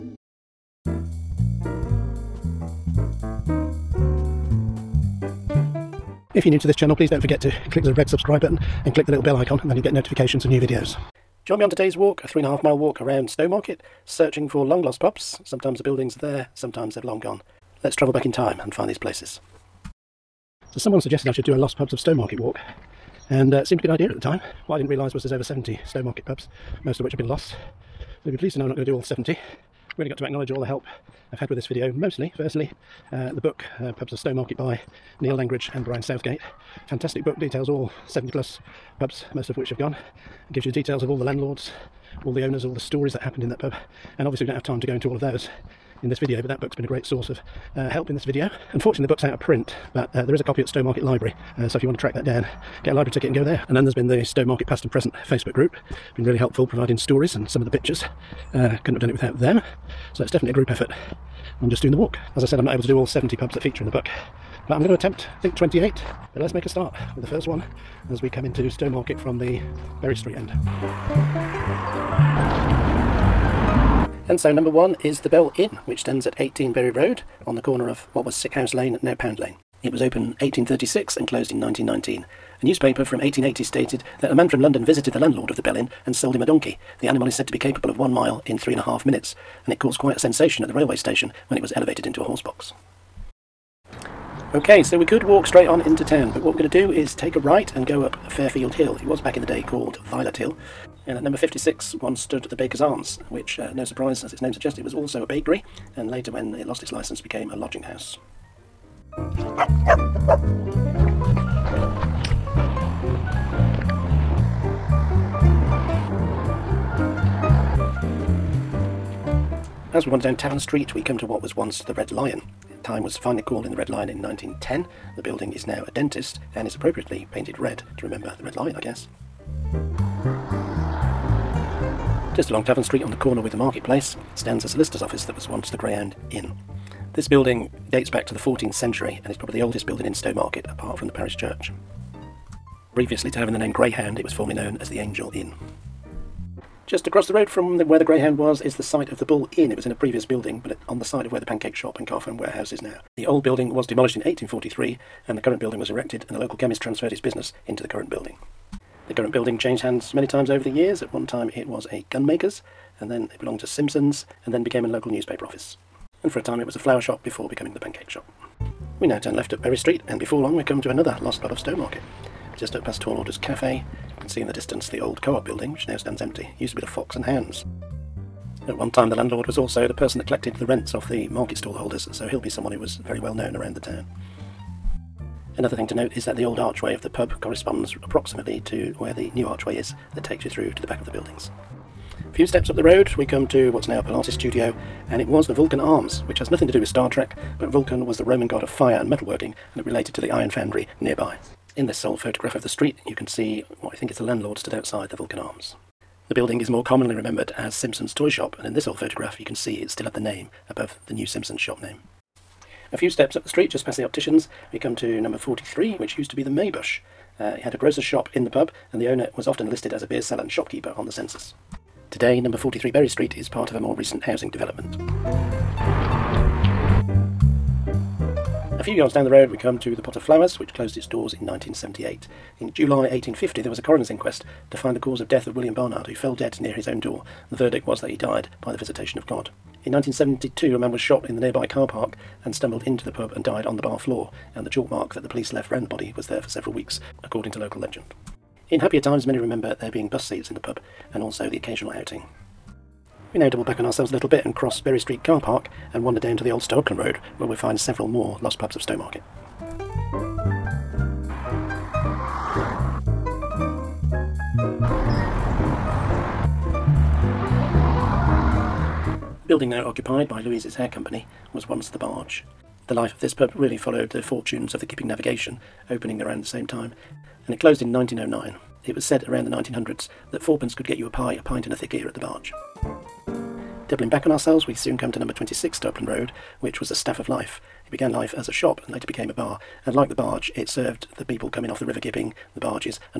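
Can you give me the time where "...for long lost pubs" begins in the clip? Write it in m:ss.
0:14.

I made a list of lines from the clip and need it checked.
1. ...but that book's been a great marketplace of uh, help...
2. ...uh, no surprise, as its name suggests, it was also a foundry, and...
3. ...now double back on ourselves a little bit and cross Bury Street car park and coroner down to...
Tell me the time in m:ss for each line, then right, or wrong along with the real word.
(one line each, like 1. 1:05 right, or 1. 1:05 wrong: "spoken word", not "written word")
1. 0:46 wrong: "source", not "marketplace"
2. 1:43 wrong: "bakery", not "foundry"
3. 4:13 wrong: "wander", not "coroner".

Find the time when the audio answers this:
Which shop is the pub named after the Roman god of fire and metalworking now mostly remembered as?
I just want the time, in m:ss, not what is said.
3:27.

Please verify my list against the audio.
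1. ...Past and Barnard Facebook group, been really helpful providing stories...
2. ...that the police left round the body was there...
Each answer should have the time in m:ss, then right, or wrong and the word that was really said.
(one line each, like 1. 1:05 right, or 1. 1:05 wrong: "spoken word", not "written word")
1. 0:54 wrong: "Present", not "Barnard"
2. 4:05 right.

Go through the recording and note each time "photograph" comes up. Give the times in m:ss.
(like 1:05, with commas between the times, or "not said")
3:22, 3:28.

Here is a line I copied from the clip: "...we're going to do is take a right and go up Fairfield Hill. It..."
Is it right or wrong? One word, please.
right.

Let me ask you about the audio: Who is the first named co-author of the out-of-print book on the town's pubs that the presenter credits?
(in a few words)
Neil Langridge.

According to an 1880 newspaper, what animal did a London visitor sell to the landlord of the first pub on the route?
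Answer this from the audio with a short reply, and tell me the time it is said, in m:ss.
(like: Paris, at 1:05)
a donkey, at 1:26.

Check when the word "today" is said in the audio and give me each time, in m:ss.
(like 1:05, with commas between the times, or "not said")
0:11, 3:42.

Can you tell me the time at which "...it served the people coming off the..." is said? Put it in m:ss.
4:50.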